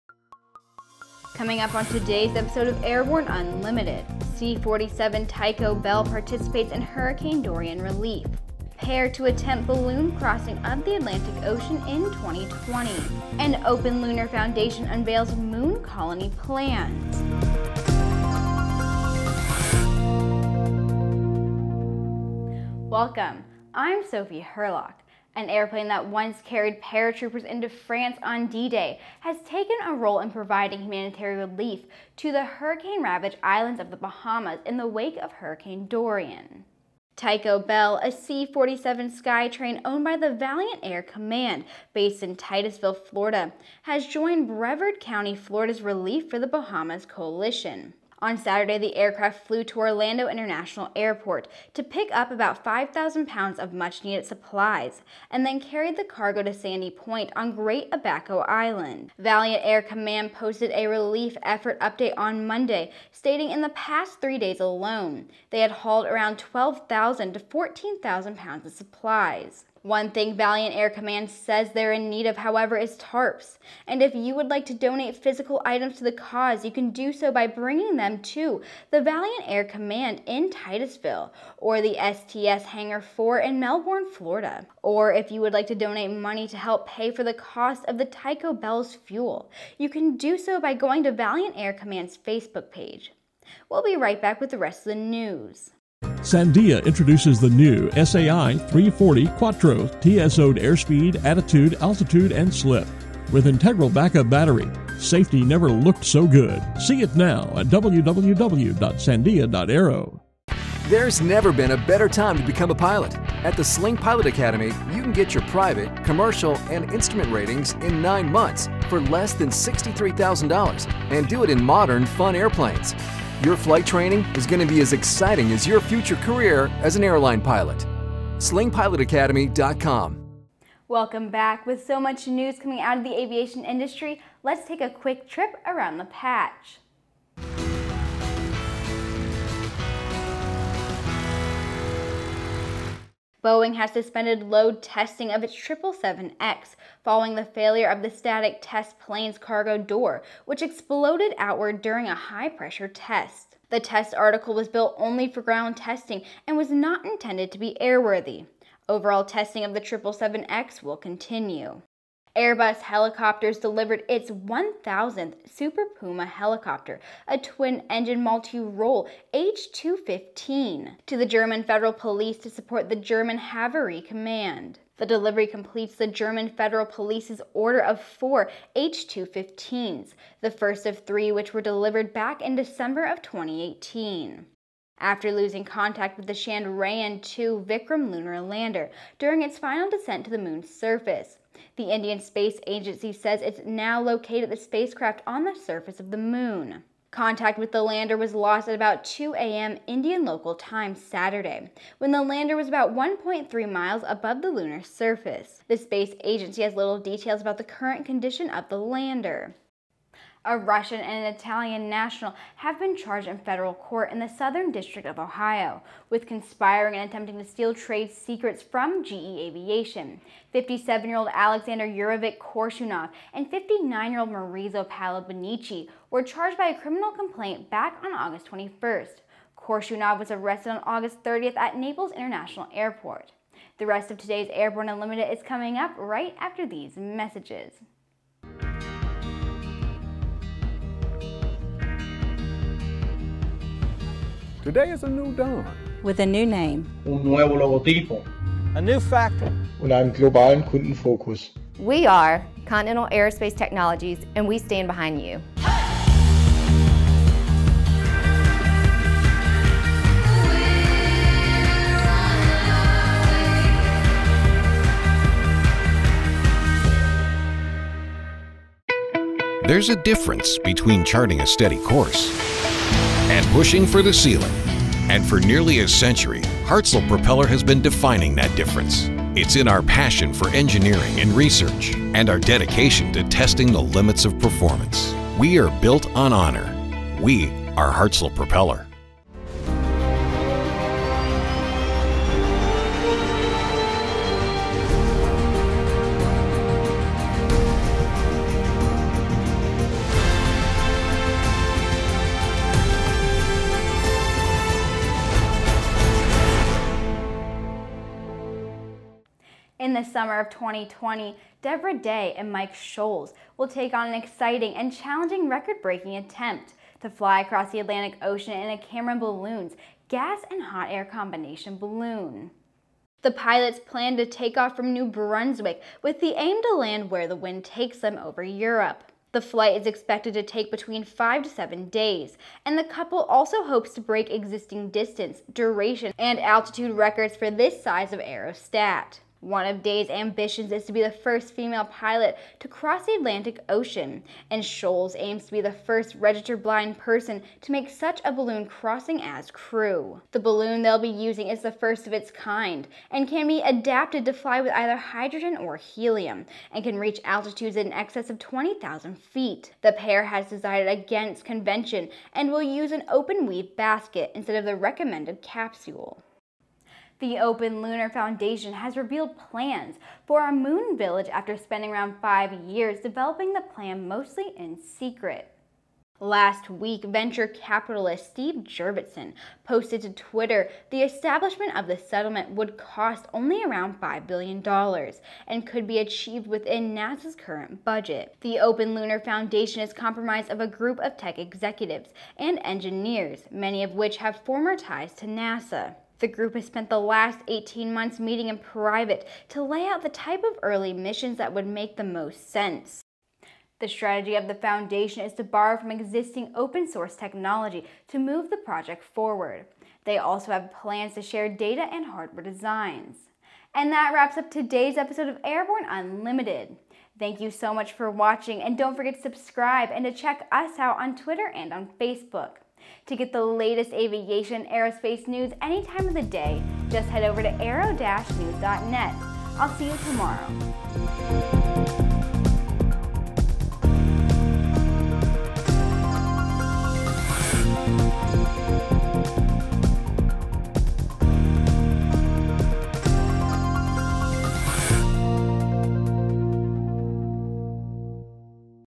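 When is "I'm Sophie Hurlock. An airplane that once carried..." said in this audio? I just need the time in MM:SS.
00:23.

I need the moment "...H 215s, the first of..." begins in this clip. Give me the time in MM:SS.
02:58.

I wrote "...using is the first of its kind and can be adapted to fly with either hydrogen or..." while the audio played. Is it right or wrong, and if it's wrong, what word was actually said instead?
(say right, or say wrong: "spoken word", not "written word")
right.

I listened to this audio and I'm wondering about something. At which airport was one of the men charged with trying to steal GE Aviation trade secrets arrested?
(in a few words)
Naples International Airport.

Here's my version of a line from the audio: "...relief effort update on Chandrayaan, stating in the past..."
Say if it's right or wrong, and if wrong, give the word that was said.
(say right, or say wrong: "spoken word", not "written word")
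wrong: "Monday", not "Chandrayaan".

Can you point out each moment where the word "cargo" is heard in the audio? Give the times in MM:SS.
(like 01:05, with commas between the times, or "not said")
00:56, 02:29.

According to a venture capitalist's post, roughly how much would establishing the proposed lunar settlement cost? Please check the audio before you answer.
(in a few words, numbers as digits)
$5 billion.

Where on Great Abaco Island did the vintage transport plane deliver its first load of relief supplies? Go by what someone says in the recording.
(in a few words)
Sandy Point.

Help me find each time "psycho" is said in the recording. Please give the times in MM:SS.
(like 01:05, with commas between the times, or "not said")
not said.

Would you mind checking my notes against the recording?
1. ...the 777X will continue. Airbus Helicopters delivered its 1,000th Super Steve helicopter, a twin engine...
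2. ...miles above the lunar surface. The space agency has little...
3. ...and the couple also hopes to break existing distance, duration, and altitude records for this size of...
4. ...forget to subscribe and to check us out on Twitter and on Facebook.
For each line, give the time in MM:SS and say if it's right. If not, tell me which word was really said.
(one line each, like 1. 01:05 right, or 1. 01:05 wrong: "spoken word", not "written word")
1. 02:39 wrong: "Puma", not "Steve"
2. 03:23 right
3. 05:32 right
4. 06:58 right.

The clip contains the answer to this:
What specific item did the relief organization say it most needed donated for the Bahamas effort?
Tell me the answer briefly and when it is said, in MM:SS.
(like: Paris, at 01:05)
Tarps, at 01:12.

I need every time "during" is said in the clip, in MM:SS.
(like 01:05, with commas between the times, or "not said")
02:31, 03:09.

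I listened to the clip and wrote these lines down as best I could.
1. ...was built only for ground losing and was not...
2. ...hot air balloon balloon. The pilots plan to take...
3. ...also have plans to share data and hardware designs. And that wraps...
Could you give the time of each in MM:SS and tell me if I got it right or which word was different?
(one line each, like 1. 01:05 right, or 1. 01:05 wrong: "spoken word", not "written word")
1. 02:34 wrong: "testing", not "losing"
2. 05:20 wrong: "combination", not "balloon"
3. 06:50 right.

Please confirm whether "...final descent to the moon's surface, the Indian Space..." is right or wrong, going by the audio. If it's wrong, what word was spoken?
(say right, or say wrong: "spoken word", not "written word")
right.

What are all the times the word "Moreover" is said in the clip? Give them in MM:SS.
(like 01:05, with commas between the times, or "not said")
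not said.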